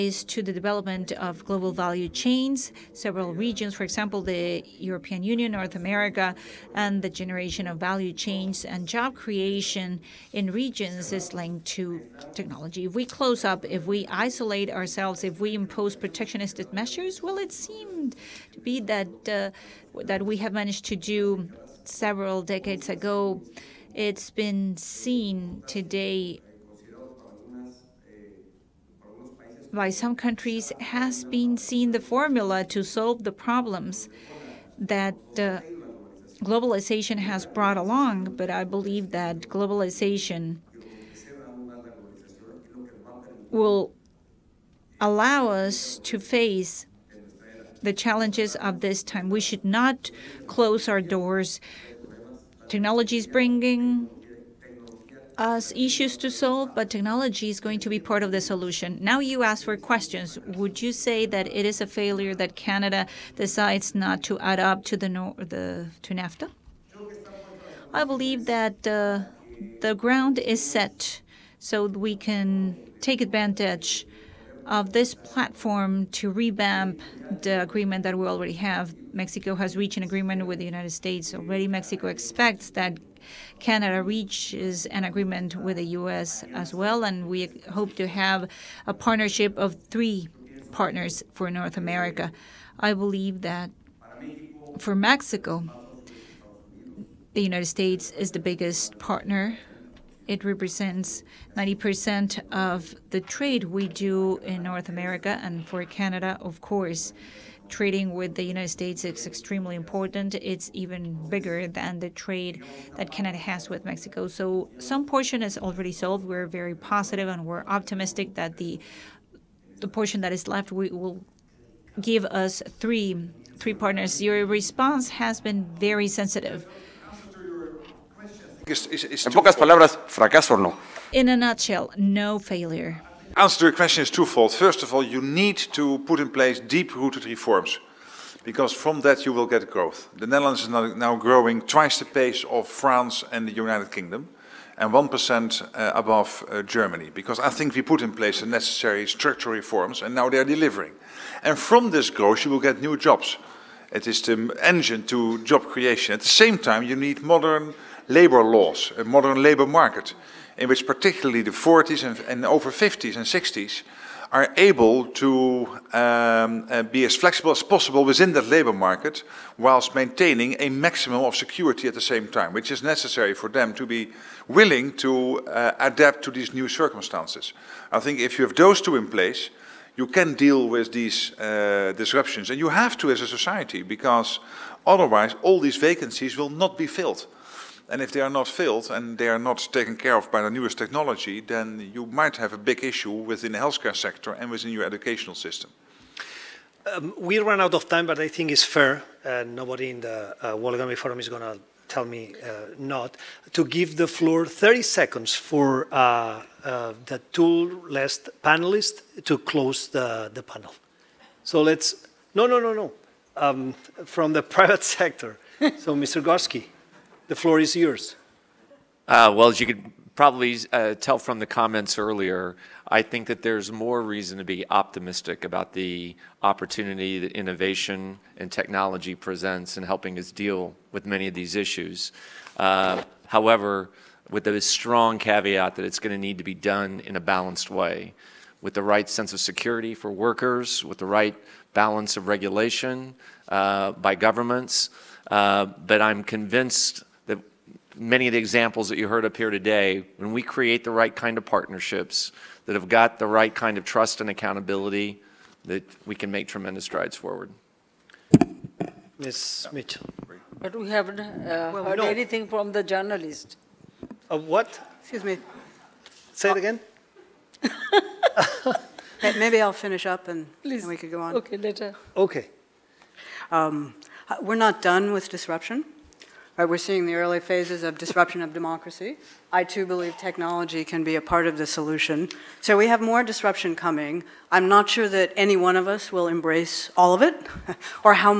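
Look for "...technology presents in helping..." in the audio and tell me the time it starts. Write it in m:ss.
3:48.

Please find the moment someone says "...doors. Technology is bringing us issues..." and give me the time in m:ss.
0:51.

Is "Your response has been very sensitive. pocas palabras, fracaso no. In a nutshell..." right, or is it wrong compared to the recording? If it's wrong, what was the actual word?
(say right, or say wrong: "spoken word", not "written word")
right.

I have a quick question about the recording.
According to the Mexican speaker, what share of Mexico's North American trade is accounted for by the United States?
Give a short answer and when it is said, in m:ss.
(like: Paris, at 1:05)
90%, at 1:41.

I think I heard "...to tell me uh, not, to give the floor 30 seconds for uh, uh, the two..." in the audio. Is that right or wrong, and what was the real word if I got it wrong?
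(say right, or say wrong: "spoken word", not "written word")
right.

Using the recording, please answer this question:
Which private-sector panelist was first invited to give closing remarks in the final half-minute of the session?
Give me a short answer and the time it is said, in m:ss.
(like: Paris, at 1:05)
Mr. Gorsky, at 3:35.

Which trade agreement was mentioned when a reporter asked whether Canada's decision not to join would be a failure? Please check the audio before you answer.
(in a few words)
NAFTA.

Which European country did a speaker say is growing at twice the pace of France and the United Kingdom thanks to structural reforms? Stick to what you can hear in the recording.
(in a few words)
The Netherlands.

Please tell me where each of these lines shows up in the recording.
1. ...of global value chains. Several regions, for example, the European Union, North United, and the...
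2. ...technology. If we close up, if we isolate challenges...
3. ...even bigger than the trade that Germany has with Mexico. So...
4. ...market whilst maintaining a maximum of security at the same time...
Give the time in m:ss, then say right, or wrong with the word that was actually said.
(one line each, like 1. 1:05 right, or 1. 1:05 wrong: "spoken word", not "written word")
1. 0:01 wrong: "America", not "United"
2. 0:12 wrong: "ourselves", not "challenges"
3. 1:50 wrong: "Canada", not "Germany"
4. 2:48 right.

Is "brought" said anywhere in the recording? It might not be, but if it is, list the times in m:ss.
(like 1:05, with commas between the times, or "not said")
0:37.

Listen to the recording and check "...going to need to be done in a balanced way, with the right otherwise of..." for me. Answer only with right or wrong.
wrong.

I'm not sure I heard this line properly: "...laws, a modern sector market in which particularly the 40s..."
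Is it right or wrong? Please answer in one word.
wrong.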